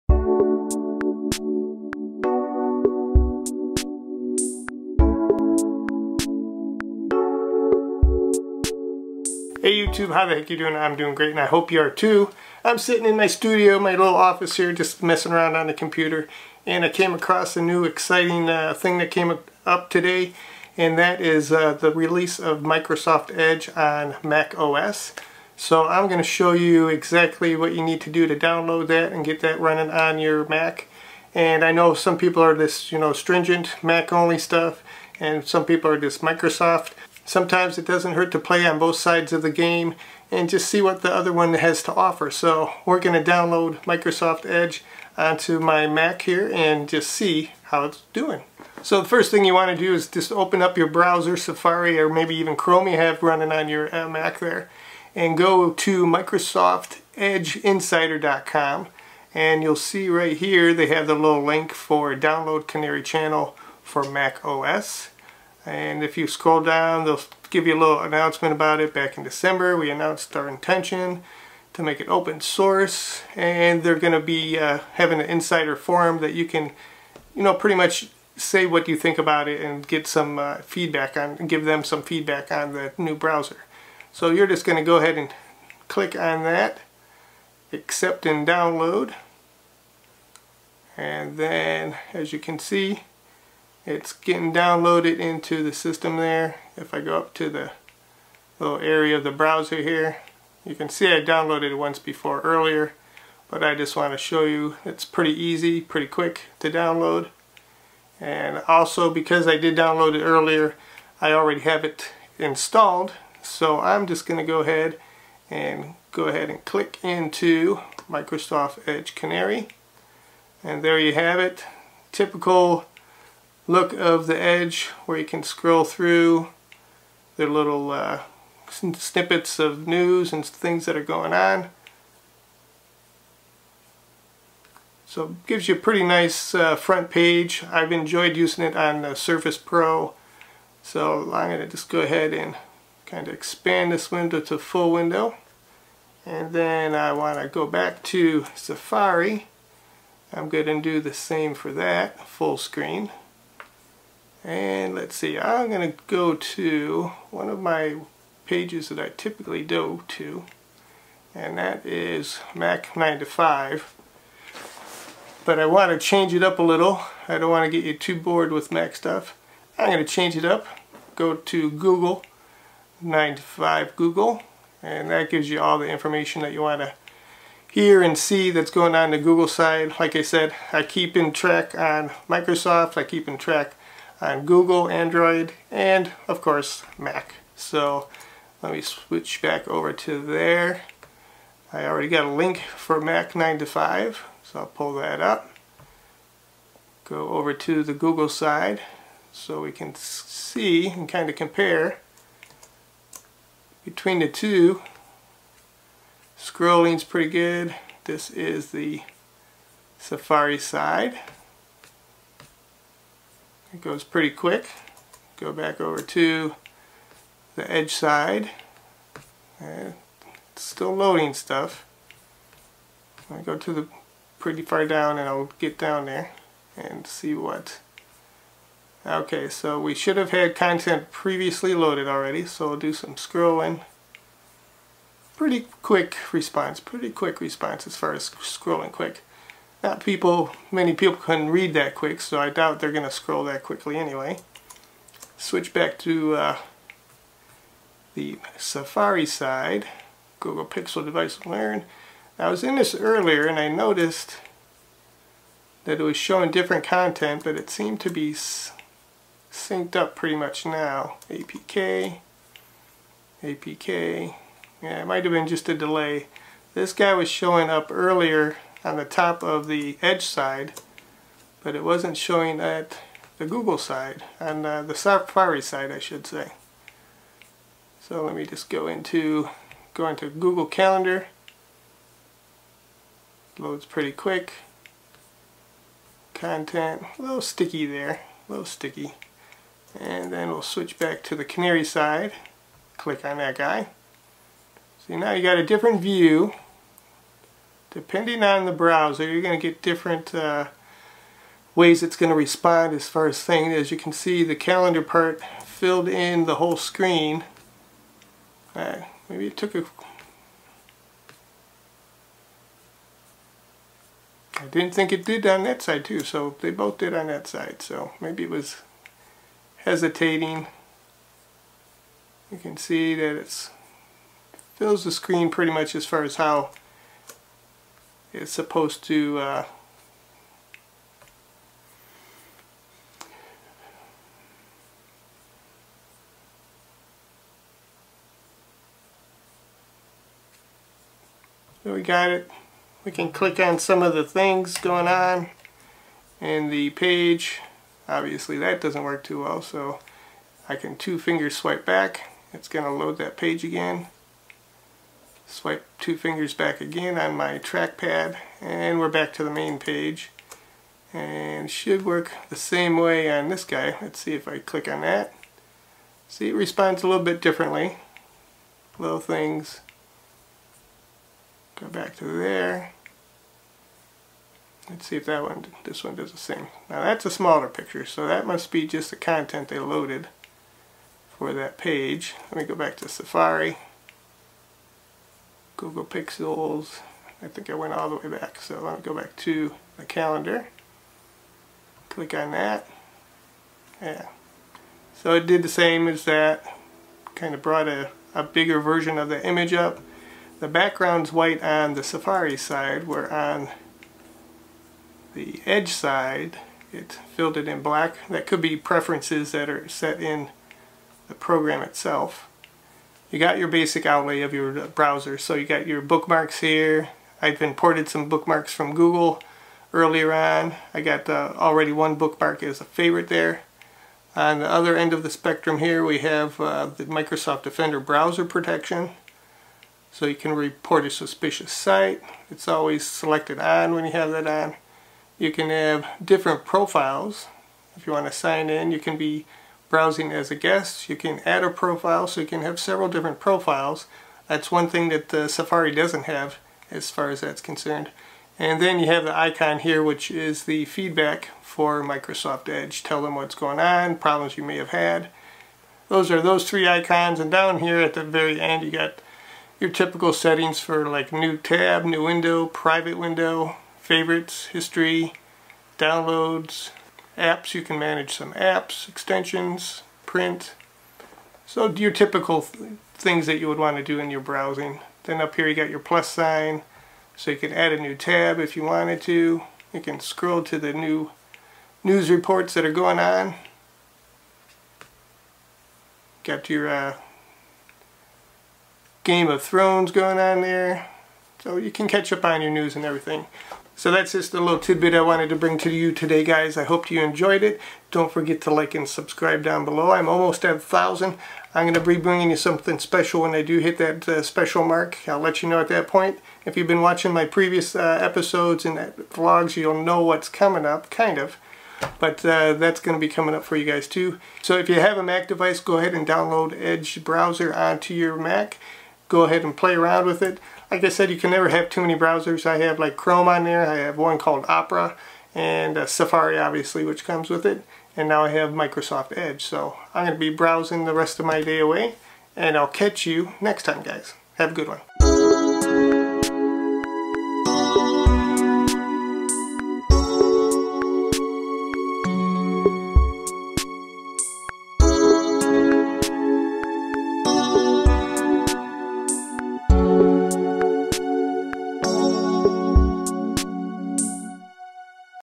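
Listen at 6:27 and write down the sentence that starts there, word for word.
I think I went all the way back, so let me go back to the calendar.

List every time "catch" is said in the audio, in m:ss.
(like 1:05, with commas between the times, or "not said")
8:12, 8:52.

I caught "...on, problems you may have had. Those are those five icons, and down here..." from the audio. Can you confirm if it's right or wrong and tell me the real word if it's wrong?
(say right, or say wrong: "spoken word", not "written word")
wrong: "three", not "five".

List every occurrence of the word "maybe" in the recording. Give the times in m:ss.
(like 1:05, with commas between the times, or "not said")
0:52, 5:09, 5:18.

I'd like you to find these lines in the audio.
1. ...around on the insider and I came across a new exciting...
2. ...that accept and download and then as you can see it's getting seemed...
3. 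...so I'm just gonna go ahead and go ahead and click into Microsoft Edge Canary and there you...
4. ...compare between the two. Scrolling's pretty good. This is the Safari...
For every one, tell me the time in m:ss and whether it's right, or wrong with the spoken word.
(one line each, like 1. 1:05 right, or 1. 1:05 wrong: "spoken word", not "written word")
1. 0:15 wrong: "computer", not "insider"
2. 1:26 wrong: "downloaded", not "seemed"
3. 1:53 right
4. 3:21 right.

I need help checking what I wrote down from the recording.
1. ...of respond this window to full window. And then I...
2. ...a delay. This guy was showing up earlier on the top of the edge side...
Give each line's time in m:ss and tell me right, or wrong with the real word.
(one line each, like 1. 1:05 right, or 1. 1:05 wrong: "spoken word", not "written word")
1. 2:23 wrong: "expand", not "respond"
2. 4:25 right.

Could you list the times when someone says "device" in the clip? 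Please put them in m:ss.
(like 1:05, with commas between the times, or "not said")
4:11, 8:35.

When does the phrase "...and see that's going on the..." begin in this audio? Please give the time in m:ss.
2:58.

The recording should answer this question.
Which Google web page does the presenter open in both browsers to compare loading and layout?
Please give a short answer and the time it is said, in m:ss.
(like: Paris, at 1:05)
Google Calendar, at 4:40.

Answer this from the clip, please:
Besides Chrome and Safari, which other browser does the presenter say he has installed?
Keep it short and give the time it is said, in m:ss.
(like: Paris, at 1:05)
Opera, at 8:44.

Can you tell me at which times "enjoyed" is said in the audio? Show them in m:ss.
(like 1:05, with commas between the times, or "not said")
2:17, 8:17.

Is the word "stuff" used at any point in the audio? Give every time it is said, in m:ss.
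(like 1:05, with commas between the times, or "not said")
0:34, 2:48, 3:41.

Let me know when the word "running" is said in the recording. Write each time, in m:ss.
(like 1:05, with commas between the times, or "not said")
0:29, 0:53.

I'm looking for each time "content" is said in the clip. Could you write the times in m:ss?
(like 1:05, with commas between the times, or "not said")
3:50, 4:16, 4:46, 6:19.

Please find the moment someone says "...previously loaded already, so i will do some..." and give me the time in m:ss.
3:51.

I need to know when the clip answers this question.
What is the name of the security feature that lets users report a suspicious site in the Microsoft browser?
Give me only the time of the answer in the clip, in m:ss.
7:07.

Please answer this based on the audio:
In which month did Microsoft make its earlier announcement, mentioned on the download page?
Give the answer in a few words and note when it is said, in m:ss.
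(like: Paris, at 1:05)
December, at 1:09.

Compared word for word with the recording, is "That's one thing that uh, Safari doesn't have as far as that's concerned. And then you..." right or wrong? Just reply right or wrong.
right.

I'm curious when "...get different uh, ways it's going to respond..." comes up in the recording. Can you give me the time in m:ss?
4:59.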